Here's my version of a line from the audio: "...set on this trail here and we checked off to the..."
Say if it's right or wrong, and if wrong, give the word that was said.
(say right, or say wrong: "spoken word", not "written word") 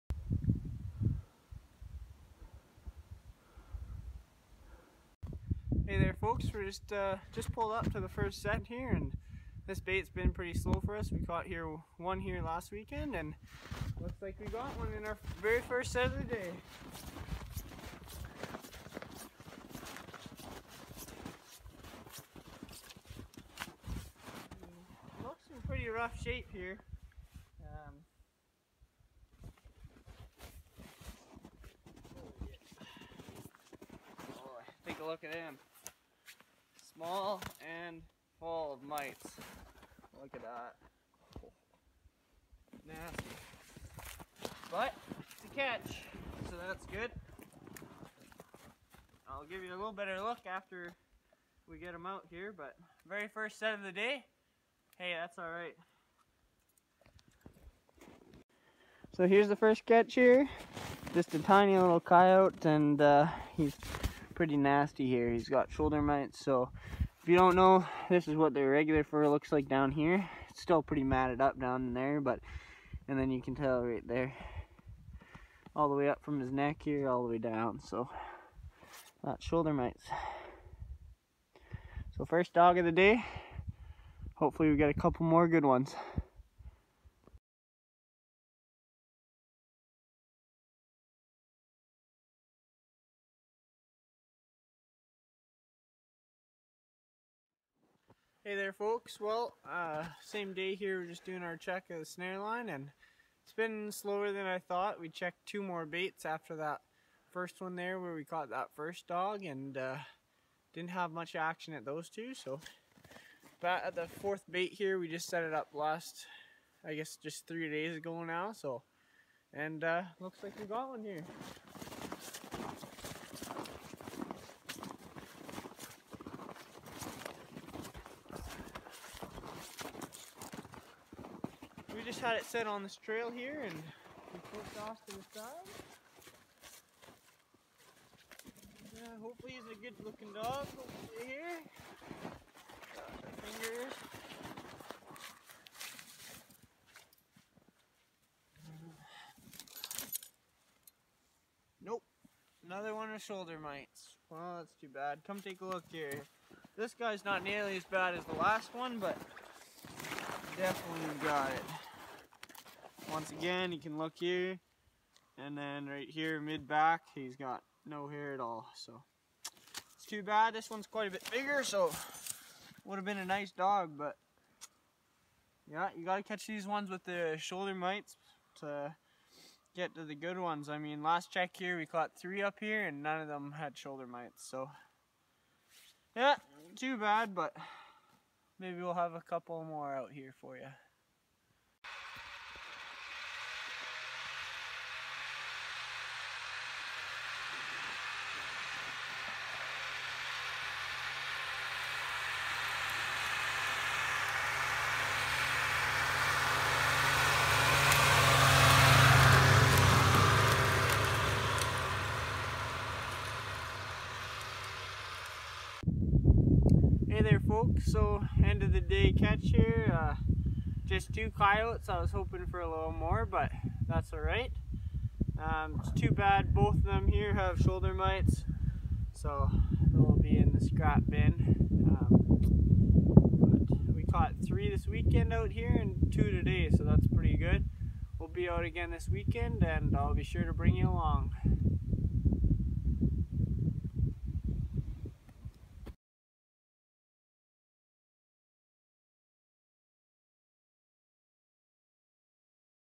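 wrong: "pushed", not "checked".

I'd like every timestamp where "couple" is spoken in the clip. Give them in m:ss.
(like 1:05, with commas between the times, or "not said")
1:24, 3:09.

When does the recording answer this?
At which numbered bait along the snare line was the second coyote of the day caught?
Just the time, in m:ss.
1:54.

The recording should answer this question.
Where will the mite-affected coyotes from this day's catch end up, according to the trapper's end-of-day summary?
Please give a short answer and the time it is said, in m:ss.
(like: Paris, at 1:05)
The scrap bin, at 3:50.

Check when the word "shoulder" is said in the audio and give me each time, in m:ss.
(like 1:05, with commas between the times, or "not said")
1:05, 1:19, 2:33, 2:57, 3:03, 3:47.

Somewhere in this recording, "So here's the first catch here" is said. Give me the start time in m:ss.
0:59.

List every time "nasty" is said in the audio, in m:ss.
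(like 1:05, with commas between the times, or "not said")
0:42, 1:04.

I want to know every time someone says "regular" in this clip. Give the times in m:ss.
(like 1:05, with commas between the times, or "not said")
1:08.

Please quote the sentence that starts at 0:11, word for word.
We caught here one here last weekend and looks like we got one in our very first set of the day.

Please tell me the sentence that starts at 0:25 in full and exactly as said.
Looks in pretty rough shape here.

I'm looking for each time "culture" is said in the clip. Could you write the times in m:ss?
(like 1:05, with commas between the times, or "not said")
not said.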